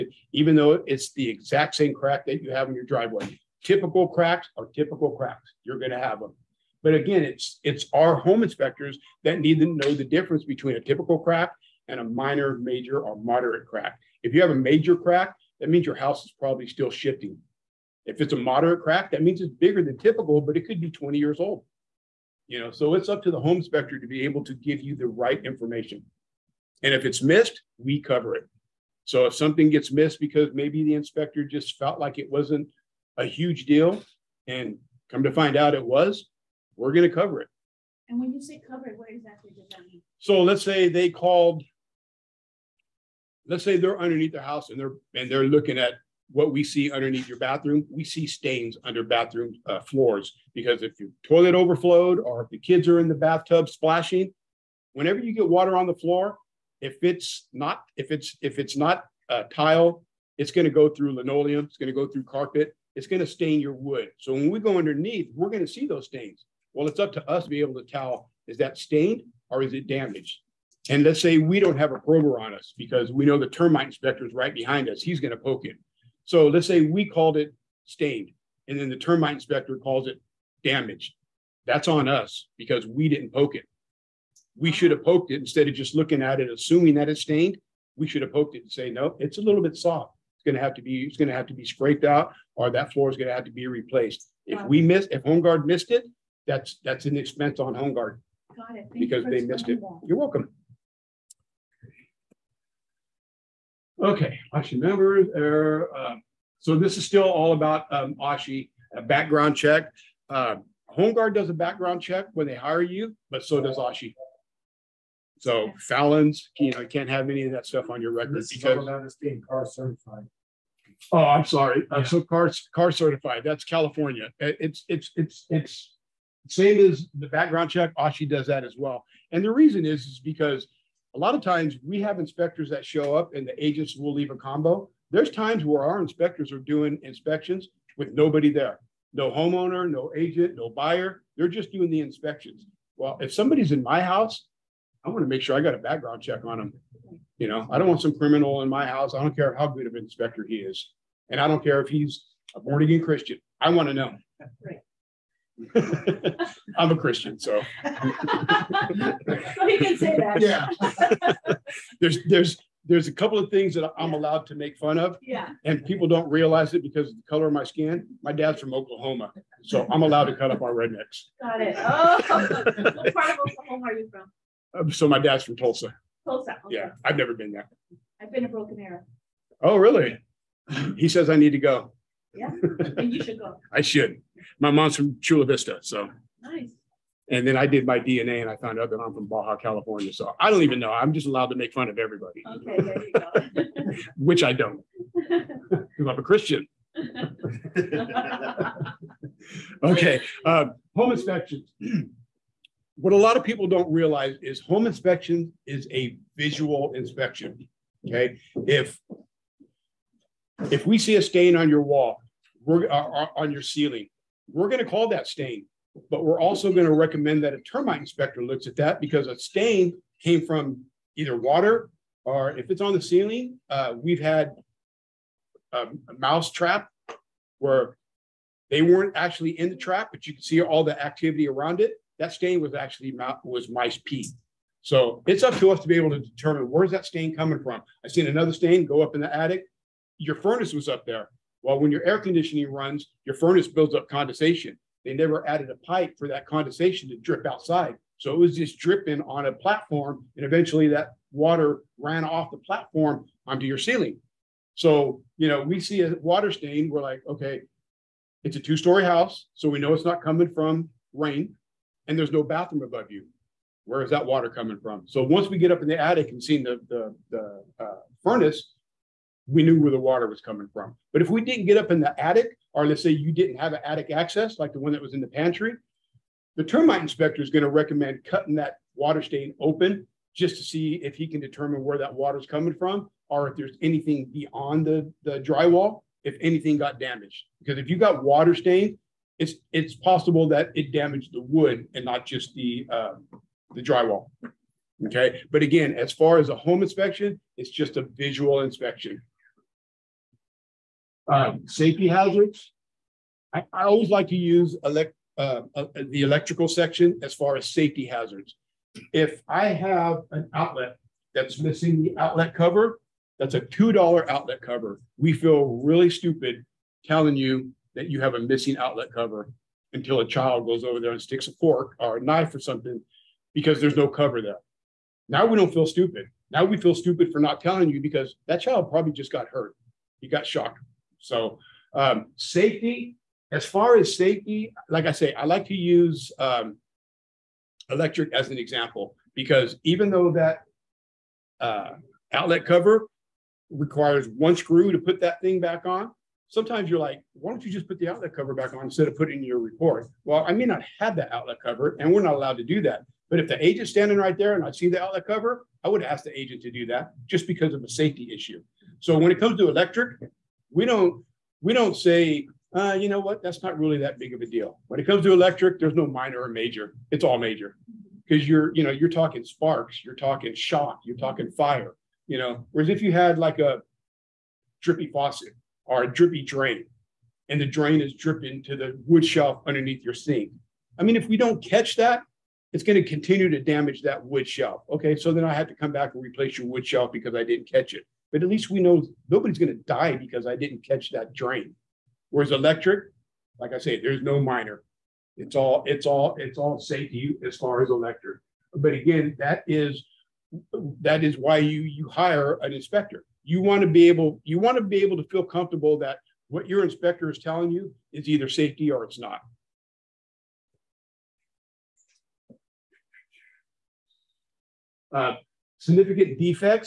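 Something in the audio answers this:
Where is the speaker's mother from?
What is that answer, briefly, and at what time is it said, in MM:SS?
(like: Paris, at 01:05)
Chula Vista, at 03:05.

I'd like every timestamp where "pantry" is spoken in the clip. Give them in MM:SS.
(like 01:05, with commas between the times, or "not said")
04:35.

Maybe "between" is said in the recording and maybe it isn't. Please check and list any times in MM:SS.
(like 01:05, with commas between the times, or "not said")
00:10.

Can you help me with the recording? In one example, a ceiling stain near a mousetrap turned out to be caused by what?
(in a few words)
Mice pee.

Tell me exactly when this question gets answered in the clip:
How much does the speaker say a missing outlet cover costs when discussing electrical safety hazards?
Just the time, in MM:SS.
05:13.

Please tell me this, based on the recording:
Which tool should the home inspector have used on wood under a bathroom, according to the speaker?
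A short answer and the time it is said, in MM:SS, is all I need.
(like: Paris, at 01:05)
A prober, at 01:11.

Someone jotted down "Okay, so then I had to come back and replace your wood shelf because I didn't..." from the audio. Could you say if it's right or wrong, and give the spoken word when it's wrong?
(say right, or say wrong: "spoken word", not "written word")
right.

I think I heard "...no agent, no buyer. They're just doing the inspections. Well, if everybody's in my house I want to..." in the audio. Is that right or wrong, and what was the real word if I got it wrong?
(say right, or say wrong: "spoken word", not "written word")
wrong: "somebody", not "everybody".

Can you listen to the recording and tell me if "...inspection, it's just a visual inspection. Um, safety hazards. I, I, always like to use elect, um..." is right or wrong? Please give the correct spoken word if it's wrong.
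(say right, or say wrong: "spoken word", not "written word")
right.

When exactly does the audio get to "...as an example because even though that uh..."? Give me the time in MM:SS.
05:38.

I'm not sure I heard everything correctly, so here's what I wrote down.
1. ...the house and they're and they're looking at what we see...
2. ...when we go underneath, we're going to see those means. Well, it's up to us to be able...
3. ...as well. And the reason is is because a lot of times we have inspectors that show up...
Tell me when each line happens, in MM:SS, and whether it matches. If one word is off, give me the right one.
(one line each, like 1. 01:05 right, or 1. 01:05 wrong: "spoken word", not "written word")
1. 00:44 right
2. 01:04 wrong: "stains", not "means"
3. 02:08 right.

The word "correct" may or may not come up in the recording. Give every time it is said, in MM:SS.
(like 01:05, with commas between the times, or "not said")
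not said.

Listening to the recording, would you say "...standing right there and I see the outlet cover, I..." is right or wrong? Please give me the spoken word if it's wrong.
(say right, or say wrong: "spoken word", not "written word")
right.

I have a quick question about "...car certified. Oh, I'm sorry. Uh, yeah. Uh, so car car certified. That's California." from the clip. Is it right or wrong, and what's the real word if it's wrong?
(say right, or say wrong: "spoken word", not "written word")
right.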